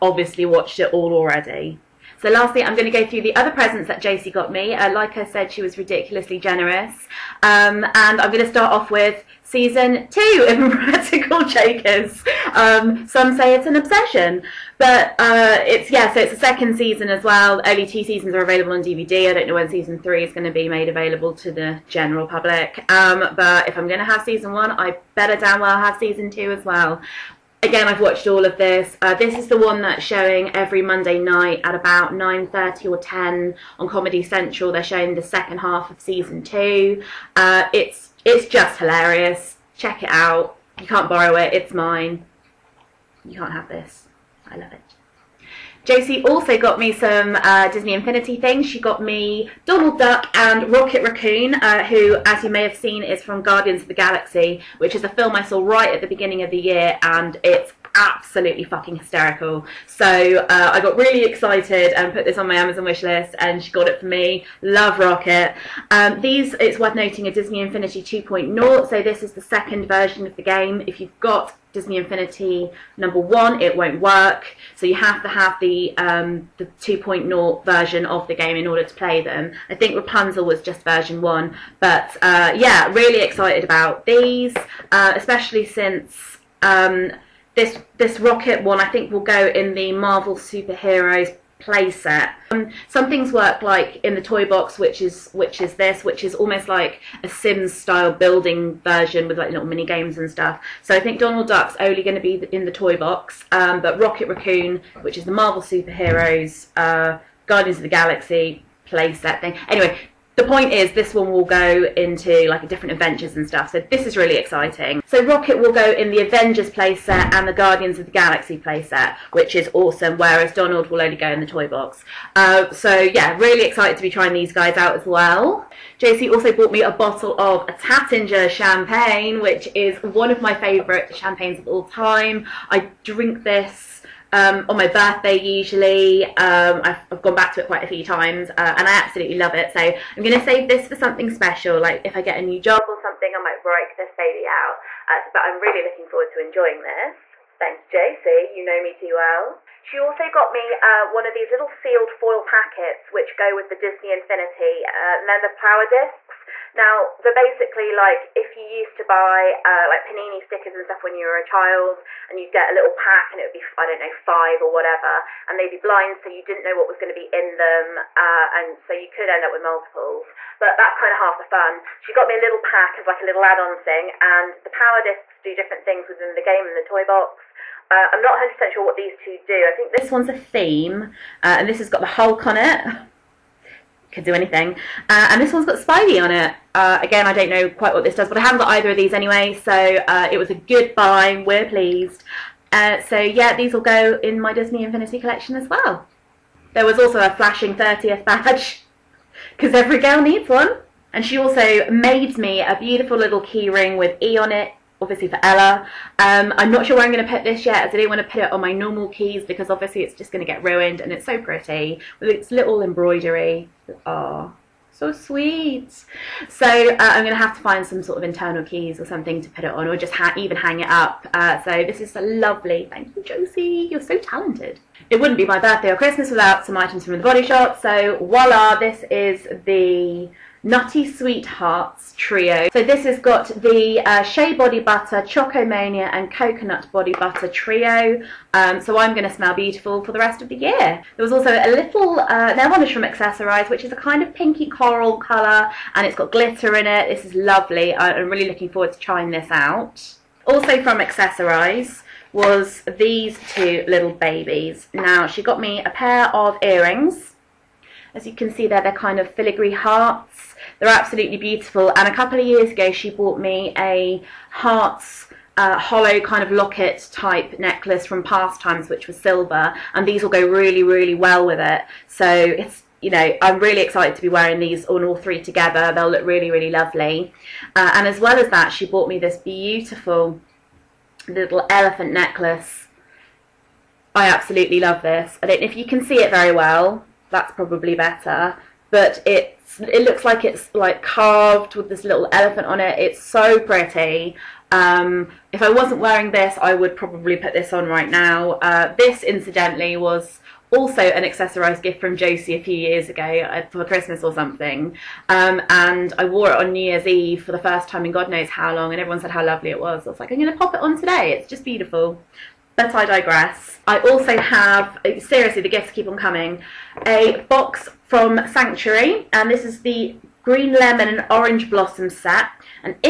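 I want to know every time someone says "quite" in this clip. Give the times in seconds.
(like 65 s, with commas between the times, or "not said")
137 s, 187 s.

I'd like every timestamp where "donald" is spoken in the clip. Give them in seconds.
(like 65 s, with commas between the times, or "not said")
49 s, 101 s, 120 s.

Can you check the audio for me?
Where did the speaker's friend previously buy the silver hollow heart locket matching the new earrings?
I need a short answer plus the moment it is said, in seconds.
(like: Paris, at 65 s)
Past Times, at 268 s.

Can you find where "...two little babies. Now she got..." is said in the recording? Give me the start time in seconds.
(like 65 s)
253 s.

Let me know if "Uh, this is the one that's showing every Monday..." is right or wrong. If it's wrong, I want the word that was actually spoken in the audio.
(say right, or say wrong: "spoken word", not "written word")
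right.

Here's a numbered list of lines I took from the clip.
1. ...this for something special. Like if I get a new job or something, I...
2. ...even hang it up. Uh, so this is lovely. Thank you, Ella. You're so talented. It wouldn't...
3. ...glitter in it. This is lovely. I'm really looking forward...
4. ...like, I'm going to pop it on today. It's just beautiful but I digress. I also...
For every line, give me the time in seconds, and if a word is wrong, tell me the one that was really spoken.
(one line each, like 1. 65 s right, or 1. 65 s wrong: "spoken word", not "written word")
1. 140 s right
2. 220 s wrong: "Josie", not "Ella"
3. 246 s right
4. 310 s right.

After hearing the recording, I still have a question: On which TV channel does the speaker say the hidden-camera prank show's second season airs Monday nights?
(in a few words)
Comedy Central.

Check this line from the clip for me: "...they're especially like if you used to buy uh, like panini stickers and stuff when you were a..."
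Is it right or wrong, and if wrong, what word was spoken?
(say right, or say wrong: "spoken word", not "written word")
wrong: "basically", not "especially".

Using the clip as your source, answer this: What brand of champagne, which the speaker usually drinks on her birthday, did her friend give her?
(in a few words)
Taittinger.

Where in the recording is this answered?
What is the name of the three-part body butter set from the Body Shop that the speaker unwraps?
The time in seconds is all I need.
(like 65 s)
230 s.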